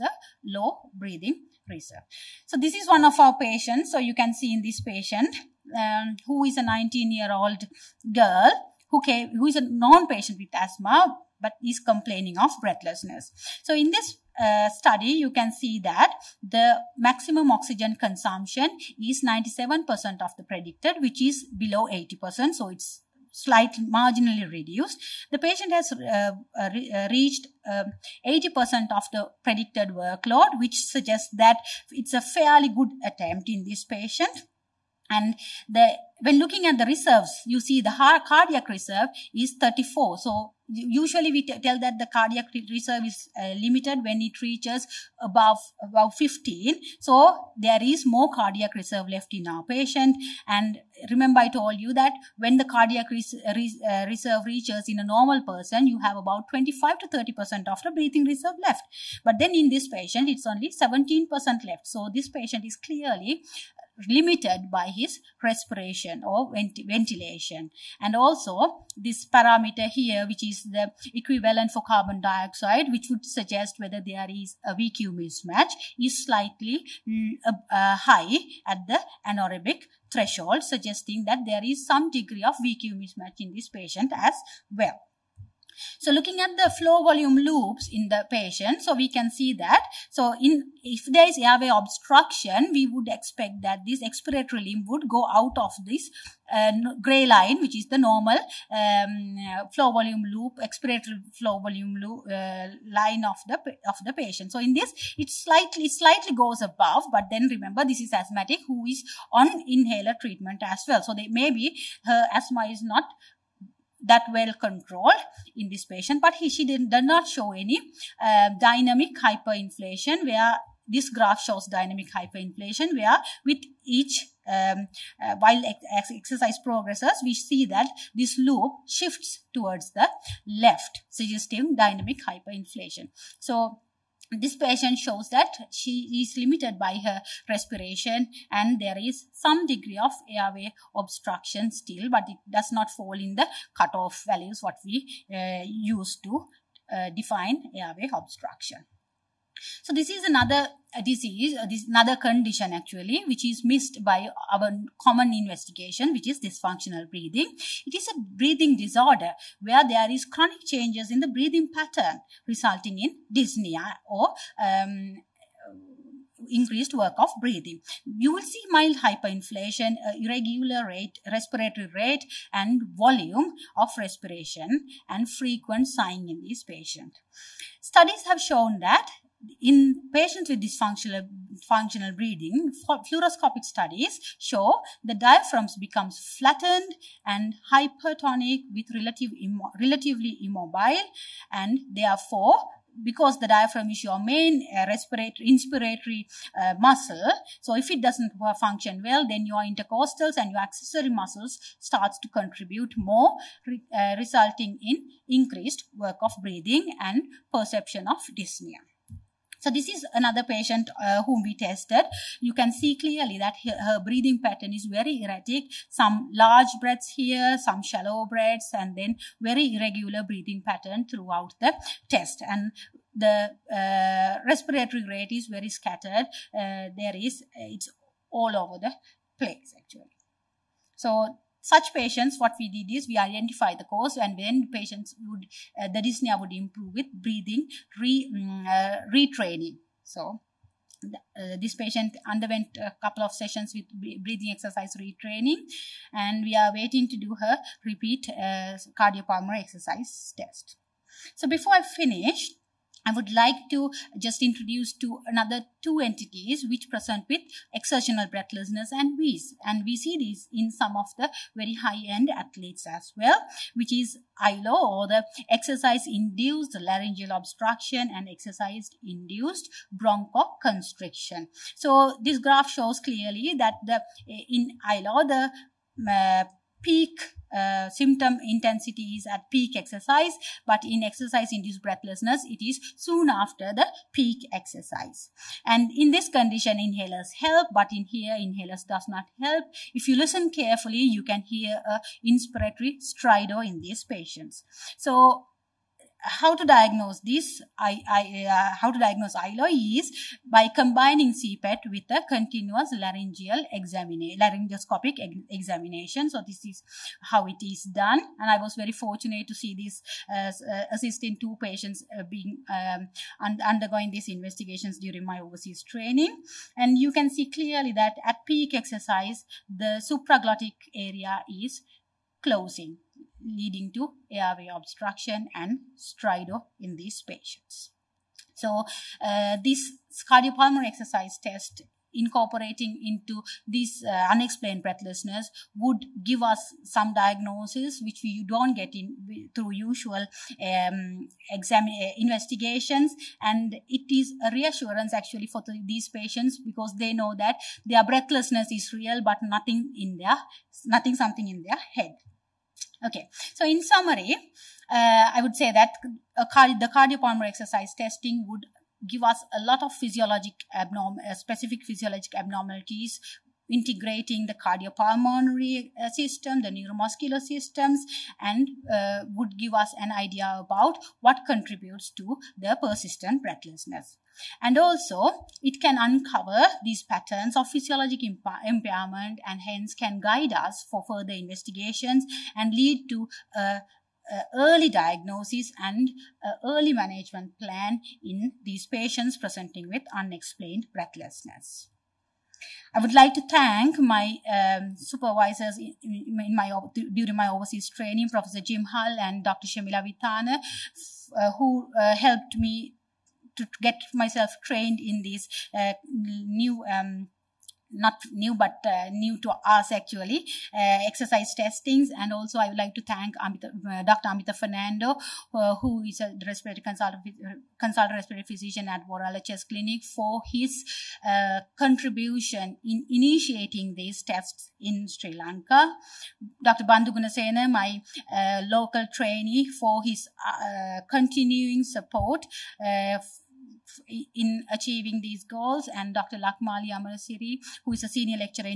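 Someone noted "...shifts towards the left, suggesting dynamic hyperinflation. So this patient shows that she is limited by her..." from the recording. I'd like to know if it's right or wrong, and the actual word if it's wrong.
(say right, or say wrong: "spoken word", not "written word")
right.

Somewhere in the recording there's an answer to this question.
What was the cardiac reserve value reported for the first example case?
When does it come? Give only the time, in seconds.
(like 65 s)
38 s.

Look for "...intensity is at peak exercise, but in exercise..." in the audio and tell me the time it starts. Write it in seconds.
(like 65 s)
278 s.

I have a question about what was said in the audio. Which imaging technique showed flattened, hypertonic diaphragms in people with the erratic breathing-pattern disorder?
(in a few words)
fluoroscopic studies.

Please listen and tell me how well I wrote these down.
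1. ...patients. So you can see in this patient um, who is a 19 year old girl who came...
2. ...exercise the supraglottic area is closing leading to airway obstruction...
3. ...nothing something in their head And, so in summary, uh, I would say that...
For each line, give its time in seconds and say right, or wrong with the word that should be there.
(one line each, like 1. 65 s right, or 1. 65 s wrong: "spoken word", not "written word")
1. 3 s right
2. 318 s right
3. 350 s wrong: "Okay", not "And".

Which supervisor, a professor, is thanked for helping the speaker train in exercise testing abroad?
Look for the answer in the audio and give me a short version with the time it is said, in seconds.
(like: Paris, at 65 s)
Jim Hull, at 398 s.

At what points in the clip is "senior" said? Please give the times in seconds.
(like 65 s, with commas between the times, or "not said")
438 s.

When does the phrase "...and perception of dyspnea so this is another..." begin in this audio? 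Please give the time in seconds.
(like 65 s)
207 s.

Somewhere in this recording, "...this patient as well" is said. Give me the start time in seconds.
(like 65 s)
83 s.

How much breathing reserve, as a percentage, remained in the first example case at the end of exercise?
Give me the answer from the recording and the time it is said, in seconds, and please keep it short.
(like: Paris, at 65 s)
17 percent, at 60 s.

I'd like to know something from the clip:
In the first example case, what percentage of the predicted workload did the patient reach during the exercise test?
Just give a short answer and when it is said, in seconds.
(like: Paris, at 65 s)
80%, at 27 s.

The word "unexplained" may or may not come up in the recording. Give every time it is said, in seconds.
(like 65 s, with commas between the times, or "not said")
334 s, 390 s.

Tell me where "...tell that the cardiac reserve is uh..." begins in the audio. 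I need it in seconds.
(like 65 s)
41 s.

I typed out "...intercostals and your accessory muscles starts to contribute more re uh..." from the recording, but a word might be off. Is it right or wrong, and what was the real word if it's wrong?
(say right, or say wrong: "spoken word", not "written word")
right.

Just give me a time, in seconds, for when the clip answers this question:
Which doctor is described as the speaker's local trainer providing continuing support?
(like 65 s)
426 s.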